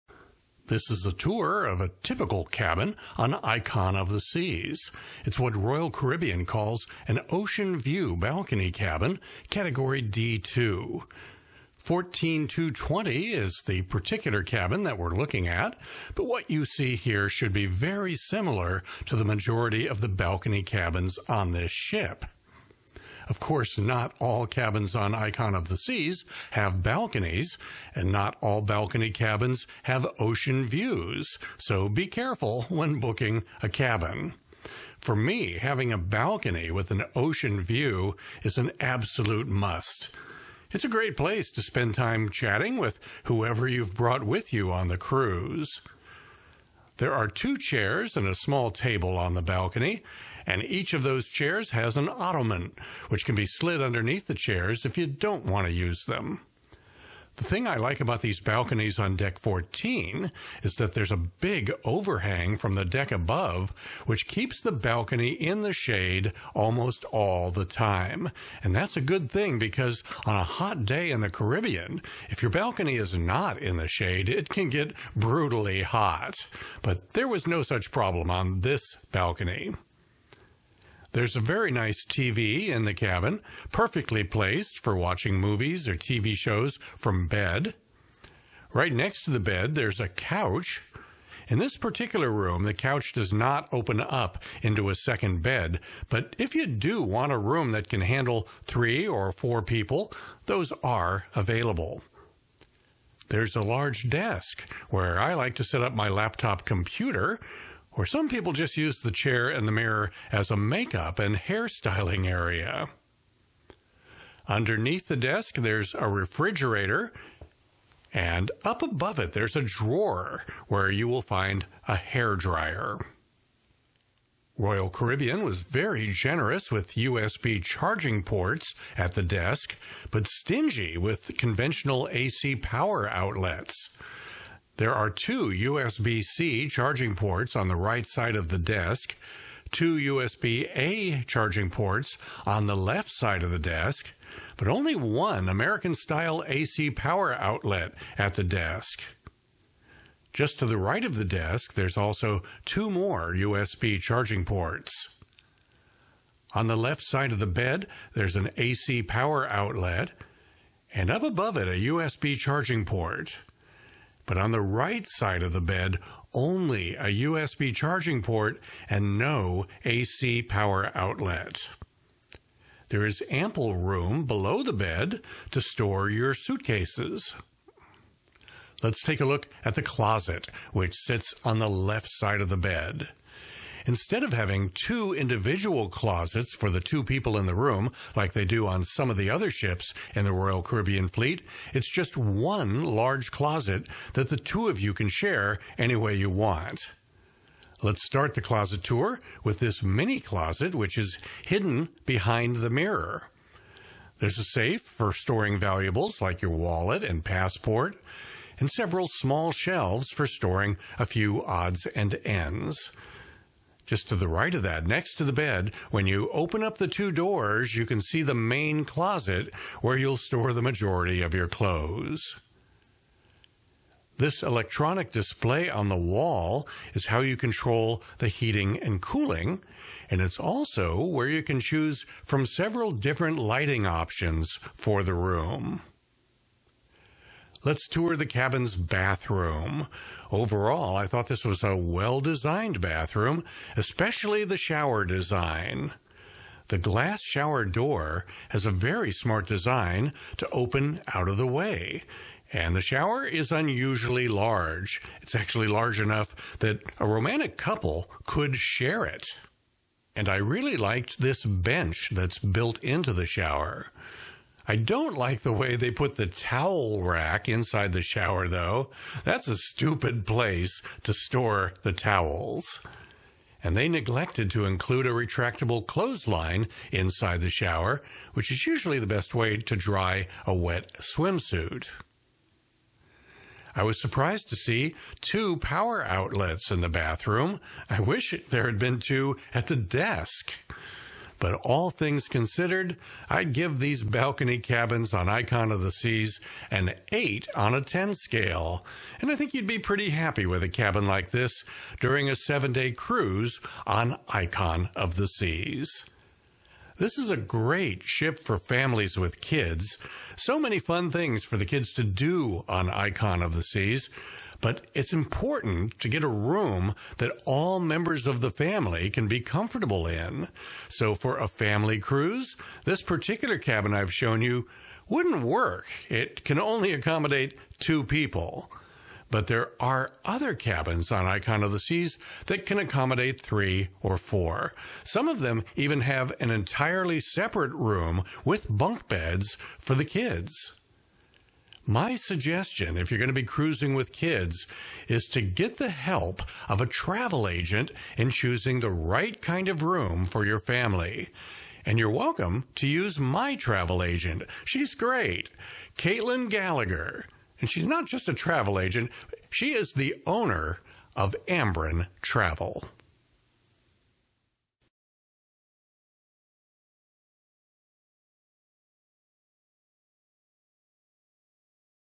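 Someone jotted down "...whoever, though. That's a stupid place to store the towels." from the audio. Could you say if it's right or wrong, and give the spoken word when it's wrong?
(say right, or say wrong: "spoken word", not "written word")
wrong: "shower", not "whoever".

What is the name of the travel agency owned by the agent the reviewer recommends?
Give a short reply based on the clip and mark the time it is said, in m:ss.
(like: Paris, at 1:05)
Ambren Travel, at 6:01.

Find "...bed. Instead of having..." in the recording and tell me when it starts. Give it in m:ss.
3:02.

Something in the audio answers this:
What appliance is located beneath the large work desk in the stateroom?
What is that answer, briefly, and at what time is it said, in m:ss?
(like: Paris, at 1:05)
refrigerator, at 1:56.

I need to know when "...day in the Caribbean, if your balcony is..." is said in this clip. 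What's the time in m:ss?
1:10.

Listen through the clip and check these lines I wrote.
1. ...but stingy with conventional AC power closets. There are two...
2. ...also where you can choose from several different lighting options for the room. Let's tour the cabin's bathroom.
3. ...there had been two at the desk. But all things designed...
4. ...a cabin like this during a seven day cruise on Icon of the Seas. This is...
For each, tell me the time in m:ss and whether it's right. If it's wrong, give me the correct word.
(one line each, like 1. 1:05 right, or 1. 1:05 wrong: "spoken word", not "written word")
1. 2:10 wrong: "outlets", not "closets"
2. 3:50 right
3. 4:48 wrong: "considered", not "designed"
4. 5:00 right.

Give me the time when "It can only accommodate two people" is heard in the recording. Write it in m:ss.
5:26.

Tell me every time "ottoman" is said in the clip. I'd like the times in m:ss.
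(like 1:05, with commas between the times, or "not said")
0:52.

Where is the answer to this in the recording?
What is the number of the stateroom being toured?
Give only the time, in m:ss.
0:11.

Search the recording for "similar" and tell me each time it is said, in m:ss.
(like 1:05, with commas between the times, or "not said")
0:18.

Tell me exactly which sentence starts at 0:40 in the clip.
It's a great place to spend time chatting with whoever you've brought with you on the cruise.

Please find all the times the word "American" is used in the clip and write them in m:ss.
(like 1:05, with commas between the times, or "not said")
2:25.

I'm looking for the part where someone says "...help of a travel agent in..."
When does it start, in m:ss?
5:45.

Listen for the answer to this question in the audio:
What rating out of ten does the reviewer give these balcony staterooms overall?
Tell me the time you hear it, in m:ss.
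4:56.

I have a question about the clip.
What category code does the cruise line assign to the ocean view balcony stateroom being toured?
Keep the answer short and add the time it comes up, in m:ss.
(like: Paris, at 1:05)
D2, at 0:09.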